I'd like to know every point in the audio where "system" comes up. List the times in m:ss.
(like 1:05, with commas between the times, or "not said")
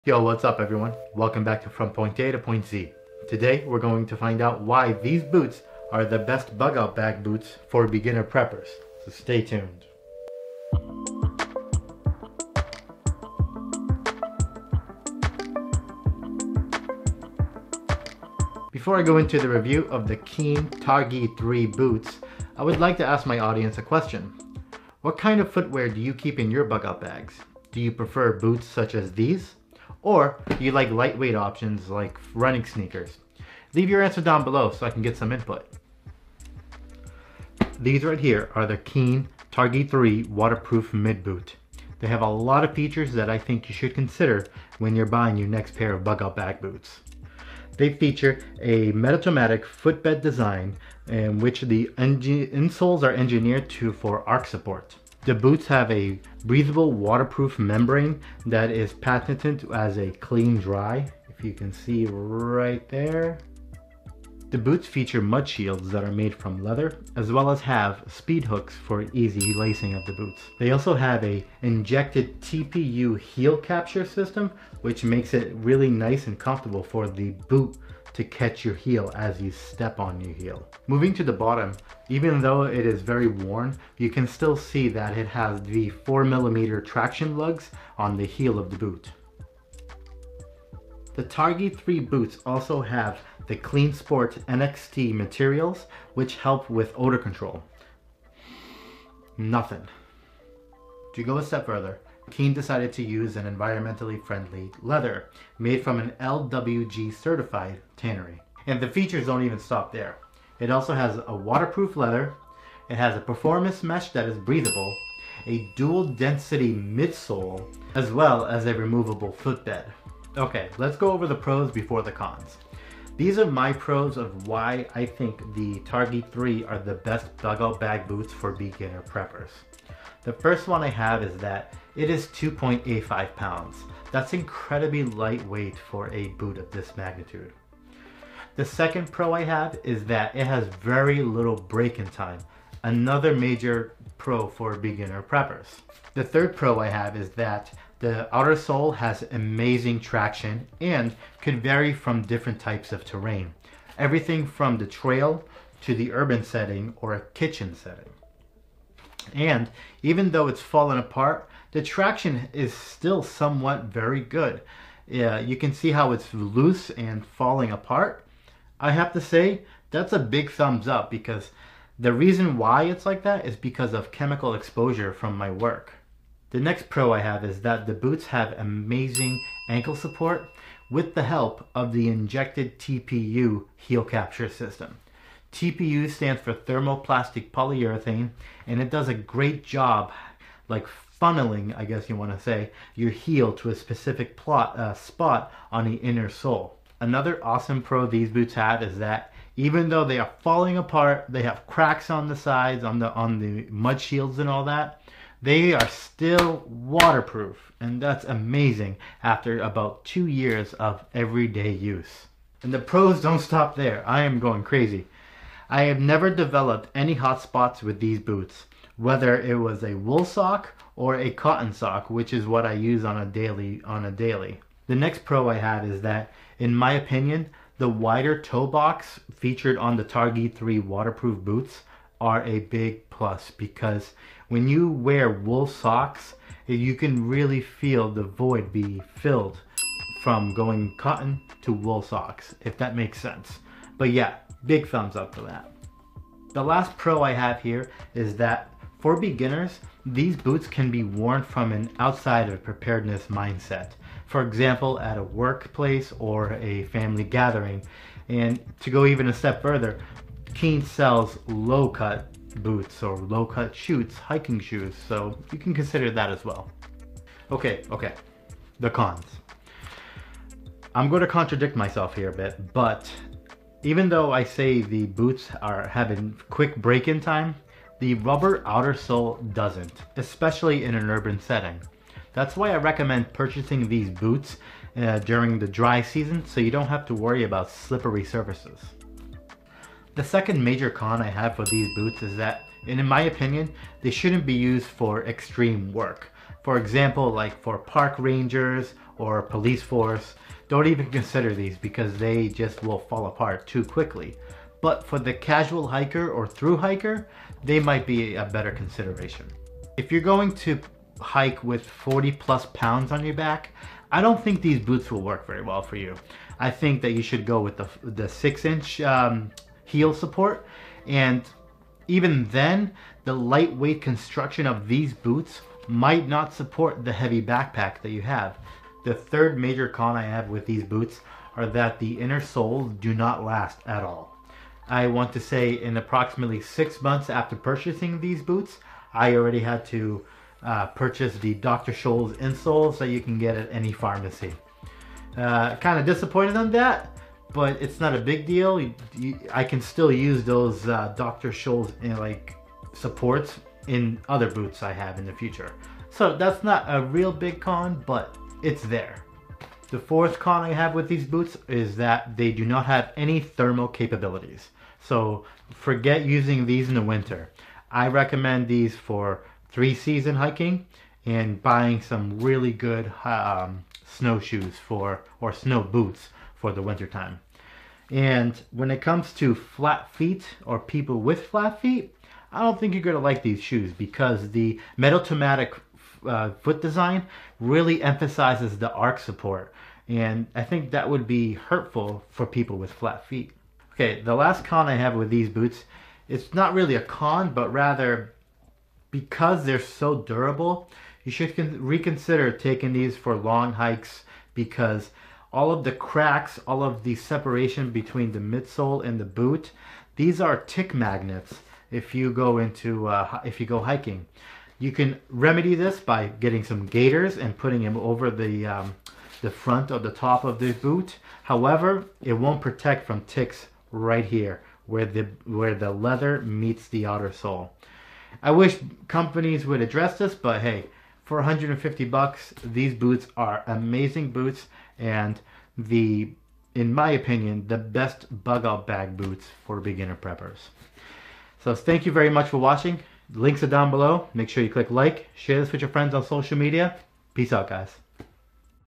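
1:14, 3:04.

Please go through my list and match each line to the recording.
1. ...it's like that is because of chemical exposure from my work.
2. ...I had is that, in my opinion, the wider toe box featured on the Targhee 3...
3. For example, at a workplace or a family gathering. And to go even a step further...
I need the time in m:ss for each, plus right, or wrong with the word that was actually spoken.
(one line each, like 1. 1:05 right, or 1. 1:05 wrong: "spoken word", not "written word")
1. 2:52 right
2. 3:45 right
3. 4:14 right.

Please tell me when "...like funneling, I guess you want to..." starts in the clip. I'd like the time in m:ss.
3:10.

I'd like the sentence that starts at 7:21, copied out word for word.
So thank you very much for watching.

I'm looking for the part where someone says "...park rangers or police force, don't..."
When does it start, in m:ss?
4:57.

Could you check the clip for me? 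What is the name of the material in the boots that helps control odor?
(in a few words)
Cleansport NXT.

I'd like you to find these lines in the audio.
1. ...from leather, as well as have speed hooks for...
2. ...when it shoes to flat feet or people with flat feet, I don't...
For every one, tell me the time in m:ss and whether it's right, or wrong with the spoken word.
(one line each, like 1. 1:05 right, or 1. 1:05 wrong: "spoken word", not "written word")
1. 1:06 right
2. 6:18 wrong: "comes", not "shoes".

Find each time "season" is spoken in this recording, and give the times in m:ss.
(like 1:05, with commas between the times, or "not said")
4:46, 6:09.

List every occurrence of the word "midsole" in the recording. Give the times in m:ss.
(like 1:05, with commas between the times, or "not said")
1:56, 6:48.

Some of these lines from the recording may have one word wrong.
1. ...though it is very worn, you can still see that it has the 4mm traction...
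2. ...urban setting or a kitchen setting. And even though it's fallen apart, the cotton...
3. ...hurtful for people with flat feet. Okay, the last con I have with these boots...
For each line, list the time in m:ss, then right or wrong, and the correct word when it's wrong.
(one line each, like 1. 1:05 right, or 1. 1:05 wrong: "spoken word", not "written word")
1. 1:22 right
2. 2:36 wrong: "traction", not "cotton"
3. 6:31 right.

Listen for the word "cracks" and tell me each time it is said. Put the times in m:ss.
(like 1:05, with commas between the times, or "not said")
3:21, 6:45.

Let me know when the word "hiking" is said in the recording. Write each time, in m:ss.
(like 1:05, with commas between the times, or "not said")
4:24, 6:10, 6:53.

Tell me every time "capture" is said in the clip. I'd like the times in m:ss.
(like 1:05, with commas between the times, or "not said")
1:13, 3:04.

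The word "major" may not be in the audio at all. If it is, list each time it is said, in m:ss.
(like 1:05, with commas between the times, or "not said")
2:23, 4:50, 5:29.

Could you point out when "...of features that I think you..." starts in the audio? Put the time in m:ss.
0:42.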